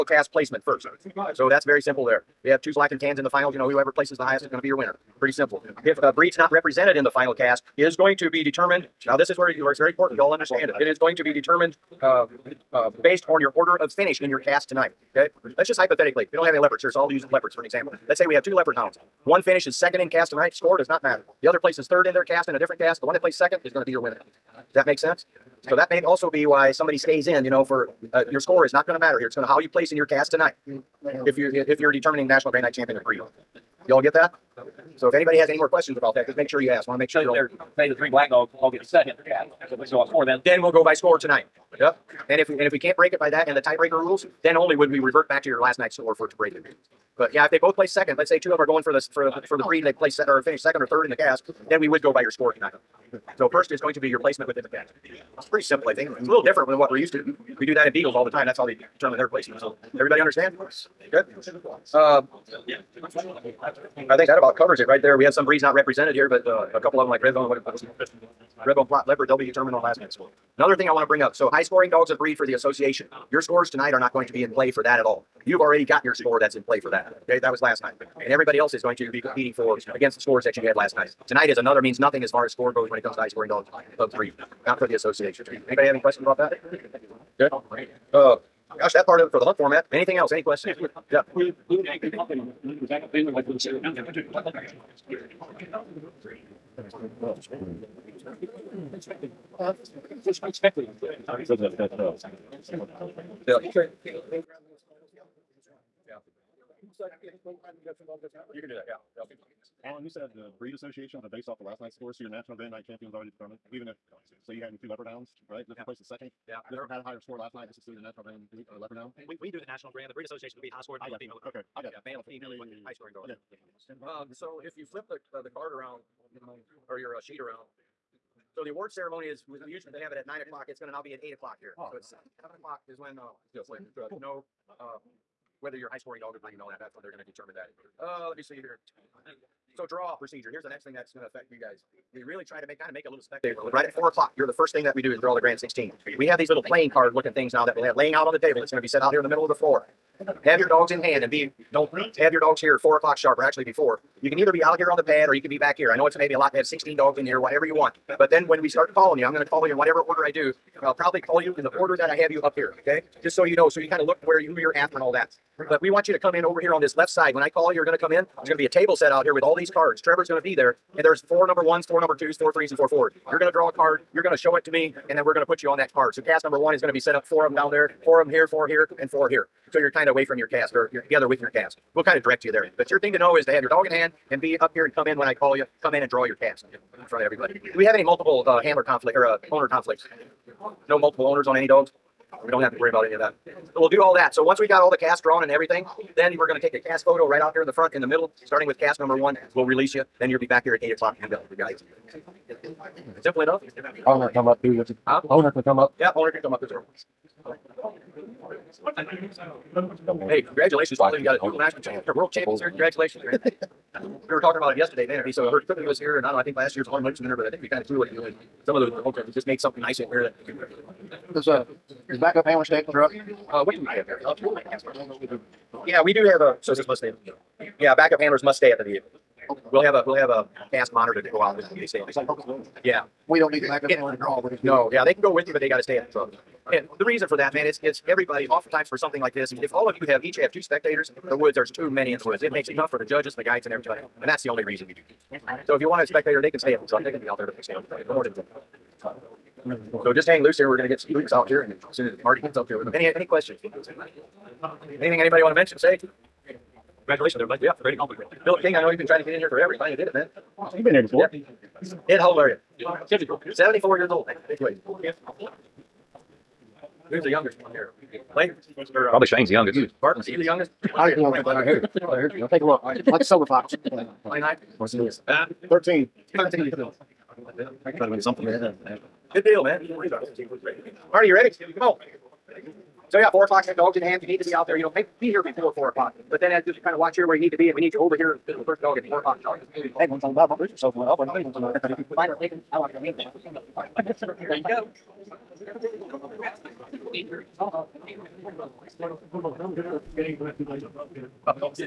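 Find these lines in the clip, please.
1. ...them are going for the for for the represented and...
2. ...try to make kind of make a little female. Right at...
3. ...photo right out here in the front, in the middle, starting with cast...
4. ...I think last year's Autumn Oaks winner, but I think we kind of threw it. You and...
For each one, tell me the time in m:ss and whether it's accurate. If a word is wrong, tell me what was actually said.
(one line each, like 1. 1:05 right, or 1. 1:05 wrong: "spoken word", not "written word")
1. 0:48 wrong: "breed", not "represented"
2. 2:22 wrong: "spectacle", not "female"
3. 3:17 right
4. 3:36 right.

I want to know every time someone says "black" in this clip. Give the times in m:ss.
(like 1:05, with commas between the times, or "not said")
0:02, 0:38.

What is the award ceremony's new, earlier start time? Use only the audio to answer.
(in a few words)
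8 o'clock.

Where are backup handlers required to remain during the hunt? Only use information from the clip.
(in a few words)
At the vehicle.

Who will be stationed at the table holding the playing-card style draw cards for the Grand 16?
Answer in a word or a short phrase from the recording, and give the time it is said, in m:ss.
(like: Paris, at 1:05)
Trevor, at 2:50.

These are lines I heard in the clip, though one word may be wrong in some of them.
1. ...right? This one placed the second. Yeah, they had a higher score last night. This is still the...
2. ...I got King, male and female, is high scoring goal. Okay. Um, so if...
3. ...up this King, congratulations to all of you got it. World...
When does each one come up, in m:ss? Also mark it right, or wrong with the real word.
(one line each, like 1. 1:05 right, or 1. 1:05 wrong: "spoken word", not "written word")
1. 1:55 right
2. 2:01 wrong: "Yeah", not "King"
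3. 3:26 wrong: "Hey", not "King".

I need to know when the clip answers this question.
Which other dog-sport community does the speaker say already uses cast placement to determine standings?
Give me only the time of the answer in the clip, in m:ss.
0:57.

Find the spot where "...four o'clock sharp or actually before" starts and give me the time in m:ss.
2:32.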